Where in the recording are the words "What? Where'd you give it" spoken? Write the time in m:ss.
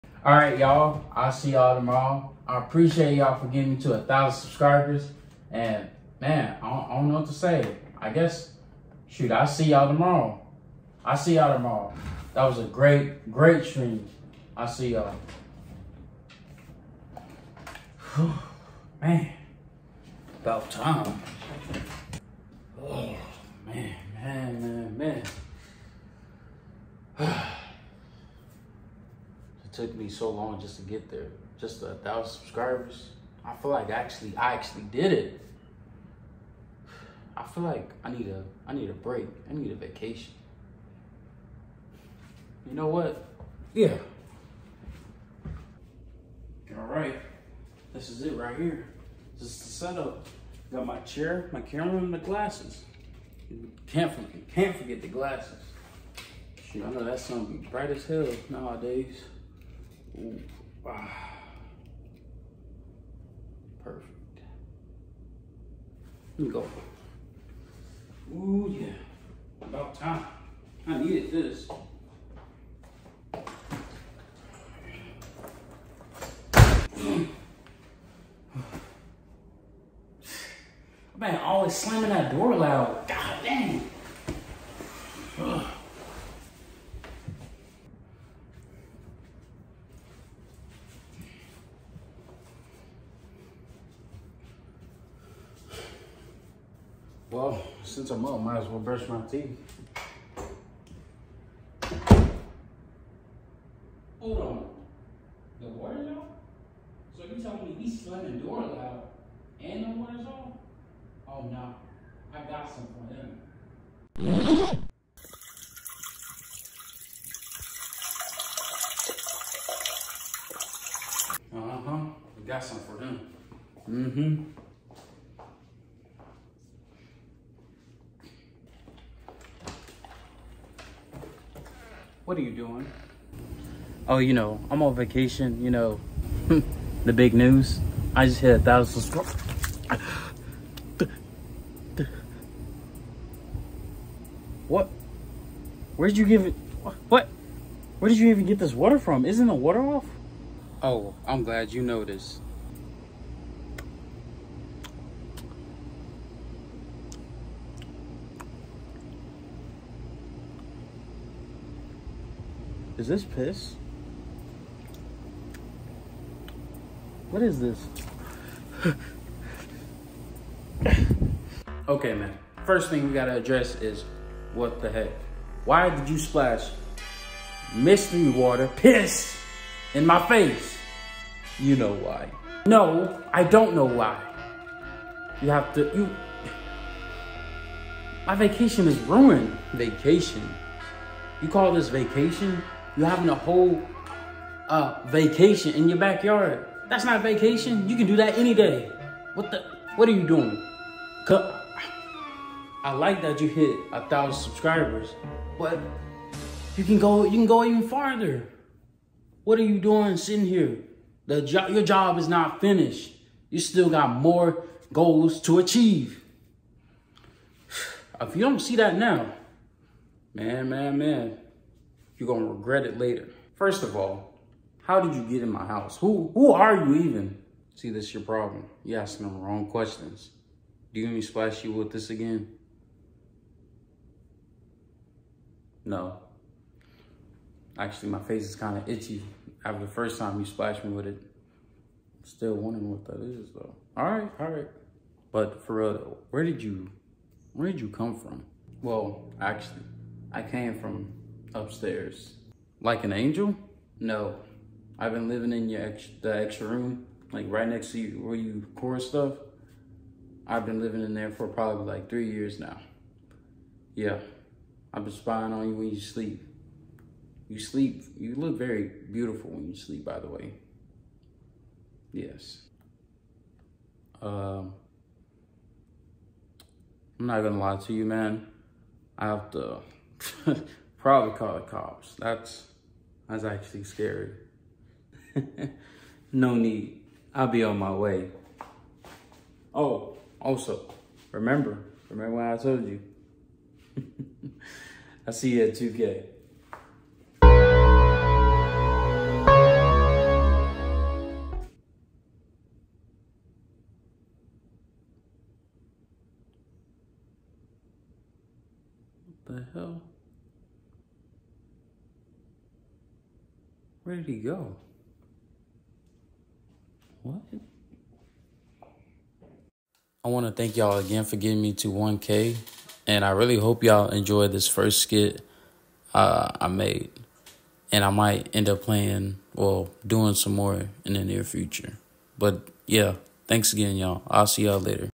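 2:24.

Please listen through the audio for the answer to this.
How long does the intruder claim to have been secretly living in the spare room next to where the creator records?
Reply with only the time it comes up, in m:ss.
4:22.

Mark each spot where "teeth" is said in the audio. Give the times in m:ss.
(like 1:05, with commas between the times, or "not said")
1:39.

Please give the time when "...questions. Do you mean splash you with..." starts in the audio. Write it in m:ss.
3:49.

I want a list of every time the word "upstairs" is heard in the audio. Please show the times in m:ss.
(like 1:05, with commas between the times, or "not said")
4:11.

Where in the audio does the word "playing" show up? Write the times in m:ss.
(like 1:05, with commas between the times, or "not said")
5:28.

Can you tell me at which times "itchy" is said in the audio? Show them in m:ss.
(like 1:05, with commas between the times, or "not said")
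3:58.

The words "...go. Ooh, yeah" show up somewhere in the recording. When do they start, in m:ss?
1:06.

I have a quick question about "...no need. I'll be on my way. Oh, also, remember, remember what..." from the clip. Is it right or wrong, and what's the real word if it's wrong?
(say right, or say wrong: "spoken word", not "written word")
right.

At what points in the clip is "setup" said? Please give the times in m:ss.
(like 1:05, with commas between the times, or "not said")
0:49.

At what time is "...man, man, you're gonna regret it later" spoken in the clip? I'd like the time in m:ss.
3:40.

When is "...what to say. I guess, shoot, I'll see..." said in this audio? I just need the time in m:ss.
0:07.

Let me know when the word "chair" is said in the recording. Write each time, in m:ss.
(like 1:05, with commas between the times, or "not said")
0:50.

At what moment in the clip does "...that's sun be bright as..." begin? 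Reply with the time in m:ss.
0:57.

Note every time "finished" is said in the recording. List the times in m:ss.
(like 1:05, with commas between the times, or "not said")
3:32.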